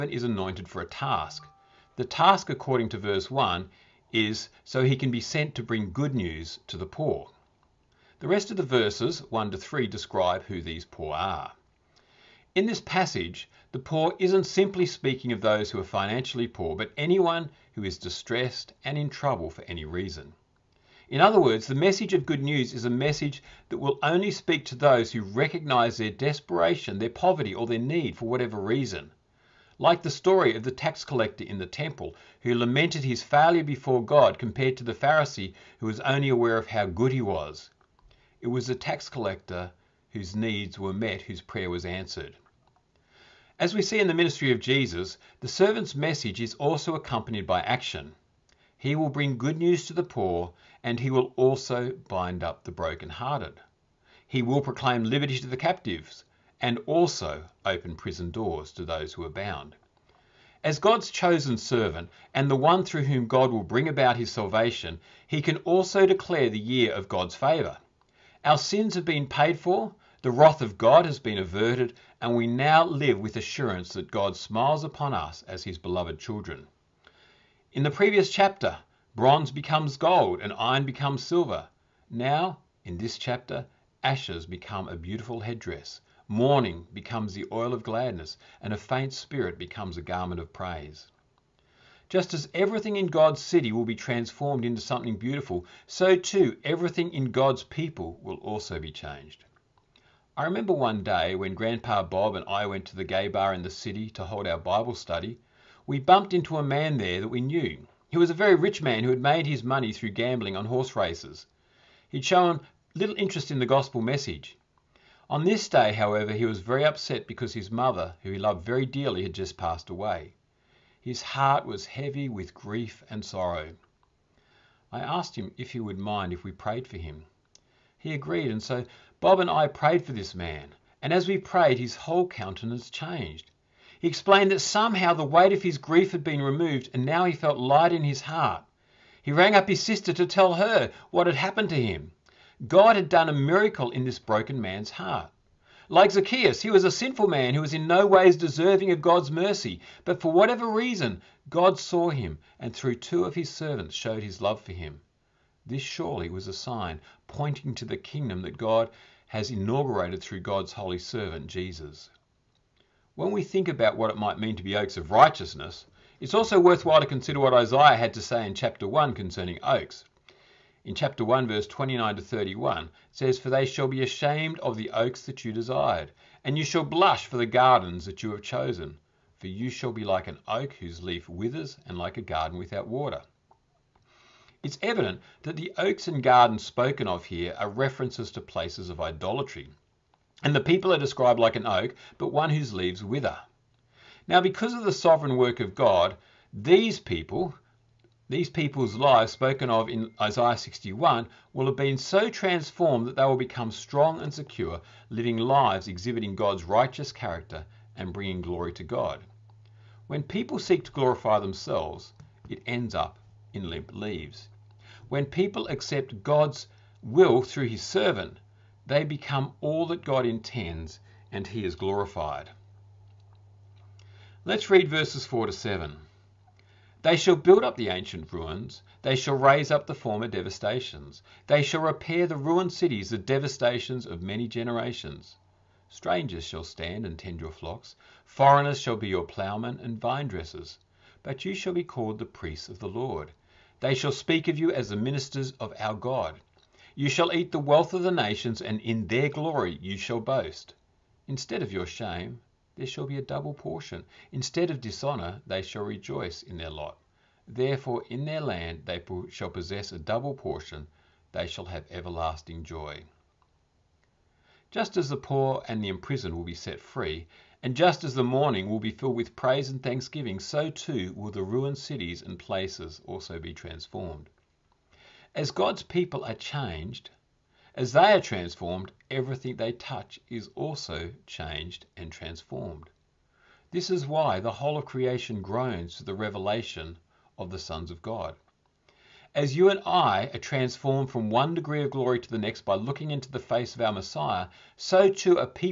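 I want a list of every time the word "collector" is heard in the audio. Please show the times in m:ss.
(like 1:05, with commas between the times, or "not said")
0:31, 0:39.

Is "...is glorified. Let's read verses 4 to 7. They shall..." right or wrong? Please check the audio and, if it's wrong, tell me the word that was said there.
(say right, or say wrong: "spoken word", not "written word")
right.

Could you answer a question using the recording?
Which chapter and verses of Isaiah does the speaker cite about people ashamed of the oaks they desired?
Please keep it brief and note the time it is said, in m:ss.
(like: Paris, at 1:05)
Chapter 1, verses 29 to 31, at 2:50.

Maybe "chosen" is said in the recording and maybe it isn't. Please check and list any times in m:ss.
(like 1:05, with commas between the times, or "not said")
1:01, 2:58.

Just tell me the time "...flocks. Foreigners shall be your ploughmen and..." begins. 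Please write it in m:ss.
3:57.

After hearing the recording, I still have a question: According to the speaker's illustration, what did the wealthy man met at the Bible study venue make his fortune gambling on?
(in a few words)
Horse races.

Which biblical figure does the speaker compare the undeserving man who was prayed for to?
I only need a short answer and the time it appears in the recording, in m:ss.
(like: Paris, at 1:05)
Zacchaeus, at 2:26.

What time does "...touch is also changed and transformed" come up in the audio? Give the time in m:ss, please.
4:39.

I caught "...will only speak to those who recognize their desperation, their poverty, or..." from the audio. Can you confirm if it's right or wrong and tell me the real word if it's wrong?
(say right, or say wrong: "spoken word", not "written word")
right.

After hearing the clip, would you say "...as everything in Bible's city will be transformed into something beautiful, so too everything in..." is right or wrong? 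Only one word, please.
wrong.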